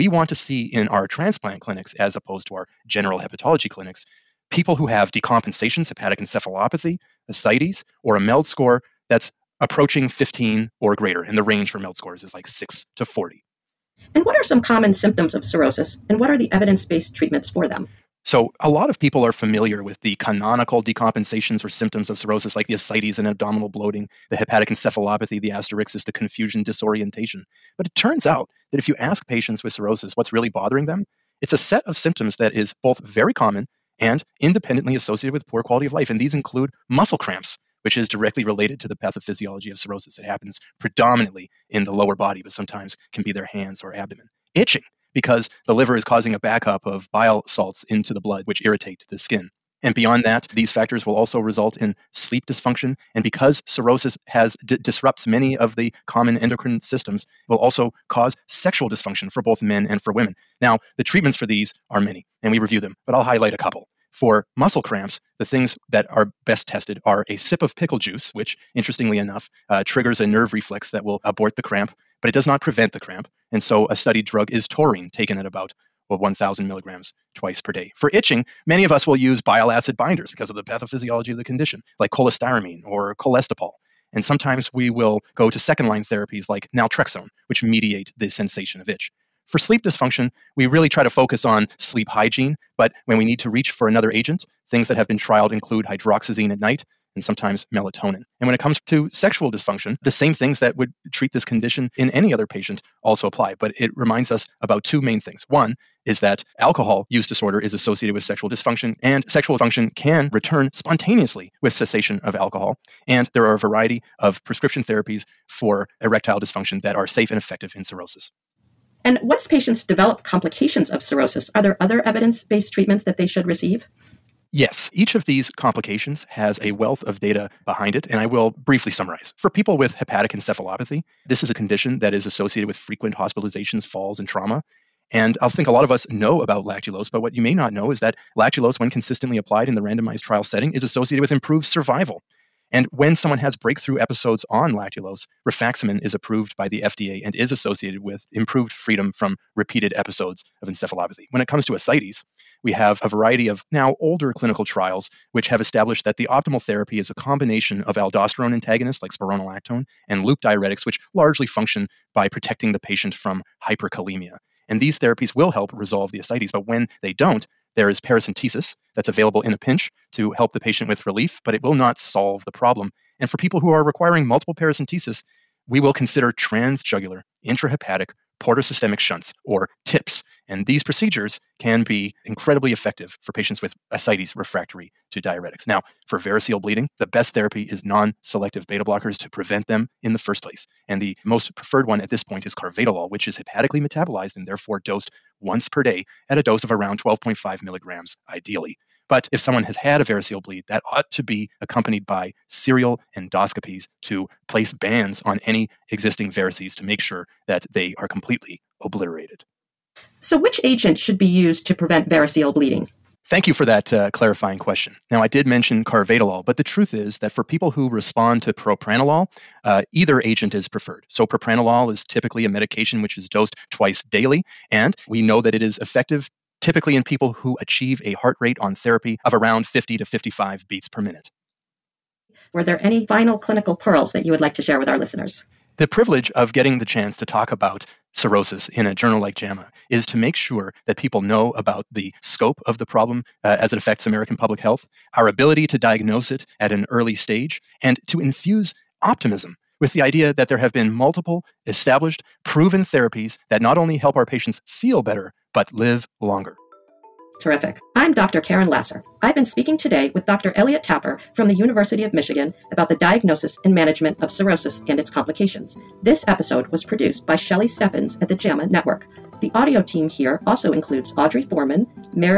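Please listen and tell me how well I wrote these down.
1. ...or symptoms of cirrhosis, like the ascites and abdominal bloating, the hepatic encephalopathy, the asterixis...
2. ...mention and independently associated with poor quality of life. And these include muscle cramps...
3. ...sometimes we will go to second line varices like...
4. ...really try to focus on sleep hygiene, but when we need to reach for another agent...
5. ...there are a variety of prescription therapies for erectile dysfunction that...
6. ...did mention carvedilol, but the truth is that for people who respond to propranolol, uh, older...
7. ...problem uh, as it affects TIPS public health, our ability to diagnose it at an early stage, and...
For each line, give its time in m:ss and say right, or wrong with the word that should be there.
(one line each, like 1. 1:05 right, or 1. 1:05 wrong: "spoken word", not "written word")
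1. 0:21 right
2. 0:33 wrong: "common", not "mention"
3. 1:24 wrong: "therapies", not "varices"
4. 1:30 right
5. 1:53 right
6. 3:35 wrong: "either", not "older"
7. 4:02 wrong: "American", not "TIPS".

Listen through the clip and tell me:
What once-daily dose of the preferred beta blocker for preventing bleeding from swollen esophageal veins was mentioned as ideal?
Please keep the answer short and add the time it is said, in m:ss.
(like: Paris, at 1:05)
12.5 milligrams, at 3:16.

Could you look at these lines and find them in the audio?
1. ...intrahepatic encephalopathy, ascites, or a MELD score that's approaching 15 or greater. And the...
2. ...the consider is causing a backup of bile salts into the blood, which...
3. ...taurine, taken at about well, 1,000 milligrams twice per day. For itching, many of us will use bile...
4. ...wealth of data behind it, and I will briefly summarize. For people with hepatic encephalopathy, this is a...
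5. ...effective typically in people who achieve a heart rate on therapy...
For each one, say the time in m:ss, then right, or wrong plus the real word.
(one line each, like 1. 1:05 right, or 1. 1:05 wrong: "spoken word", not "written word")
1. 0:05 wrong: "hepatic", not "intrahepatic"
2. 0:45 wrong: "liver", not "consider"
3. 1:14 right
4. 2:06 right
5. 3:45 right.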